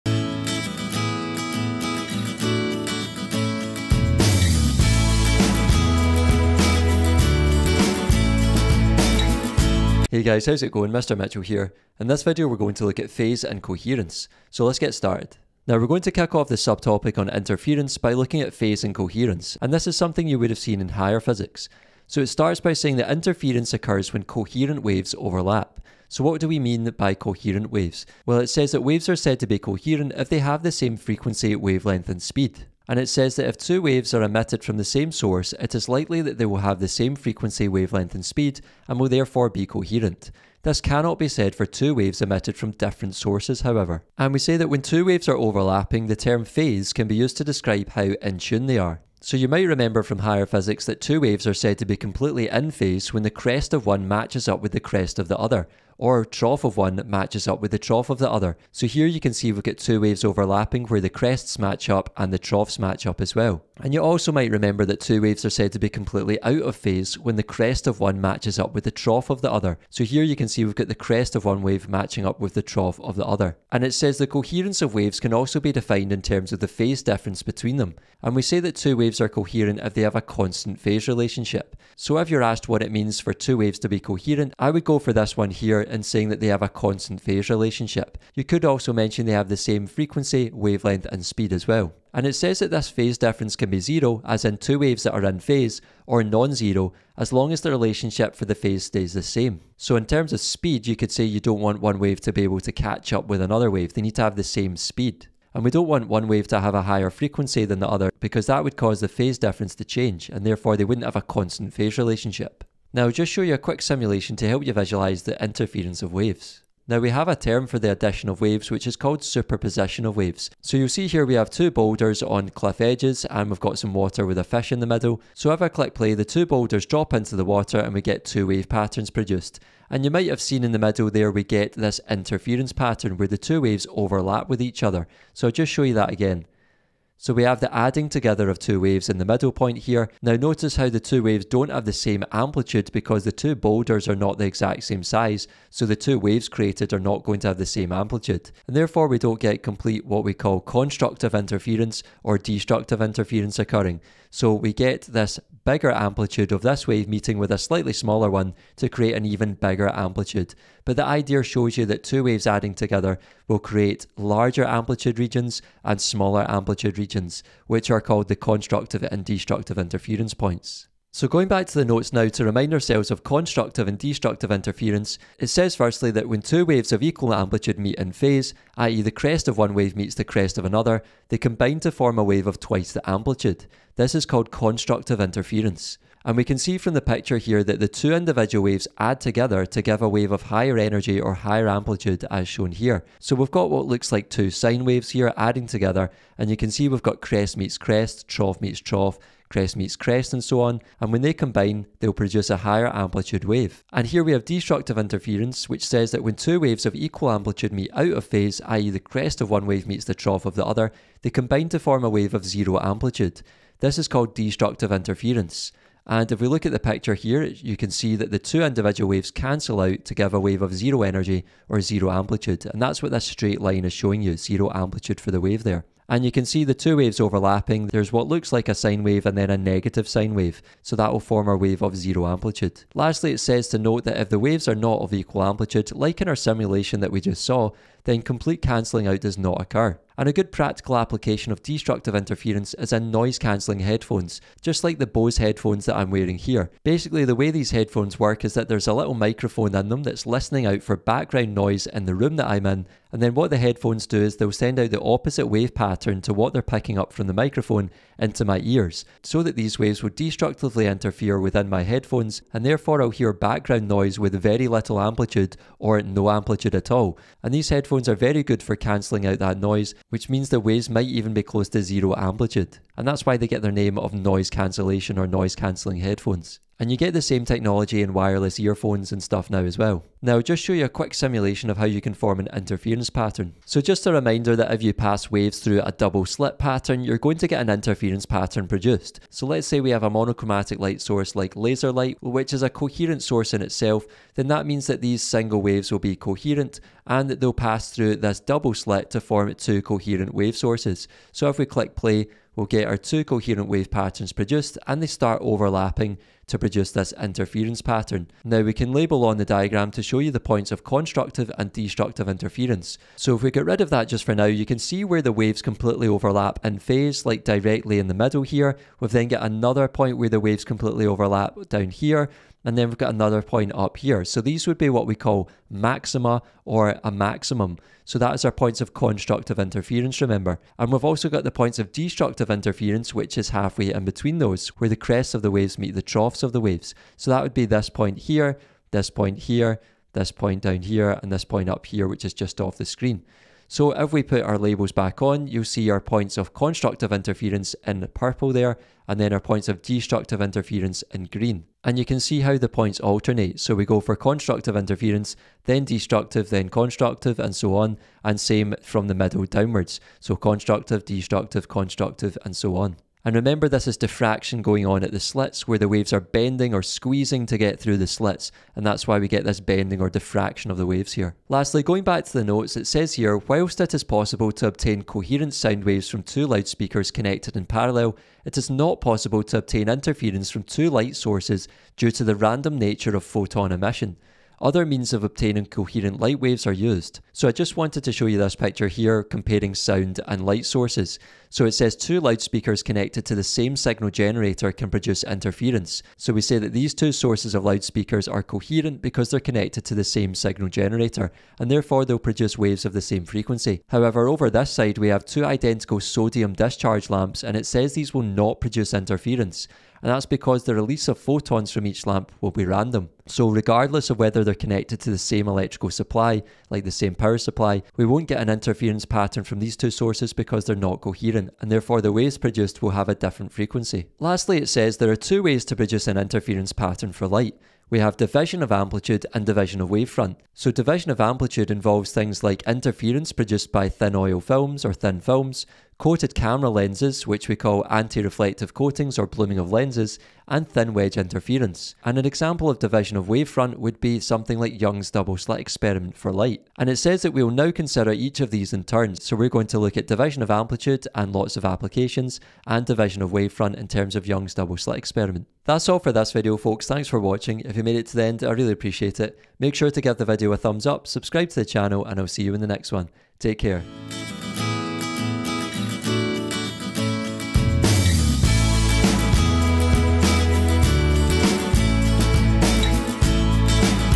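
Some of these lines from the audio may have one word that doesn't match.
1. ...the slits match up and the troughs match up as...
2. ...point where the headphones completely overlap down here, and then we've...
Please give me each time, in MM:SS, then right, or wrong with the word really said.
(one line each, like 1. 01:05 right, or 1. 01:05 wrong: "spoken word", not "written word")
1. 01:00 wrong: "crests", not "slits"
2. 05:19 wrong: "waves", not "headphones".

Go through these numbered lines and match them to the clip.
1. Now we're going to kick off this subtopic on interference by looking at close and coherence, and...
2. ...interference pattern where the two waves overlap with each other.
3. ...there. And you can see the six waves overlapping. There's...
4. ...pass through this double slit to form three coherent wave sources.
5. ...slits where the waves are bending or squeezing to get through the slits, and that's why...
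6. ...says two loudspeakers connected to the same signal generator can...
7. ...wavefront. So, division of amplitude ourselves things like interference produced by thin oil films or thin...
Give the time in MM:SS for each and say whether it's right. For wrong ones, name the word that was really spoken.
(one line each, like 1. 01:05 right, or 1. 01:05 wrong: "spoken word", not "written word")
1. 00:15 wrong: "phase", not "close"
2. 02:12 right
3. 03:45 wrong: "two", not "six"
4. 04:57 wrong: "two", not "three"
5. 06:05 right
6. 06:31 right
7. 07:09 wrong: "involves", not "ourselves".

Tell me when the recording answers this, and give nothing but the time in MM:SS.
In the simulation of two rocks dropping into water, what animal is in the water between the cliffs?
02:04.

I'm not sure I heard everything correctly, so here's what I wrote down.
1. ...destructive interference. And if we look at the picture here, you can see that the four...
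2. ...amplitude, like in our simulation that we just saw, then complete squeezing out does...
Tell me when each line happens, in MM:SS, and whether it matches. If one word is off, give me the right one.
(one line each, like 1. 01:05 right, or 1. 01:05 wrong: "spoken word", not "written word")
1. 03:34 wrong: "two", not "four"
2. 03:55 wrong: "cancelling", not "squeezing".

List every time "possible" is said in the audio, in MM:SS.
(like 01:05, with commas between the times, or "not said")
06:14, 06:19.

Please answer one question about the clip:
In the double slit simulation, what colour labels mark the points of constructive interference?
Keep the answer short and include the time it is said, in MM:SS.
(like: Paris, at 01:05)
Purple, at 05:48.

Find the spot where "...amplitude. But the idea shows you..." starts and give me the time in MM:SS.
02:39.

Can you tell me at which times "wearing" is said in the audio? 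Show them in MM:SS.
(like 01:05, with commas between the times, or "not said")
04:06.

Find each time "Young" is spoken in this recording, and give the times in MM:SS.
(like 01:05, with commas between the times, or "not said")
07:24, 07:34.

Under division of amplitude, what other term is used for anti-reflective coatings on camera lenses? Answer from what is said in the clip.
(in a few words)
Blooming of lenses.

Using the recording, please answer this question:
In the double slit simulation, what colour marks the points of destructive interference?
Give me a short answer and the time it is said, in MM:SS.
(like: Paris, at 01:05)
Green, at 05:51.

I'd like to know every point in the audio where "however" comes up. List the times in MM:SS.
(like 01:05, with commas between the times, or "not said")
00:43, 06:43.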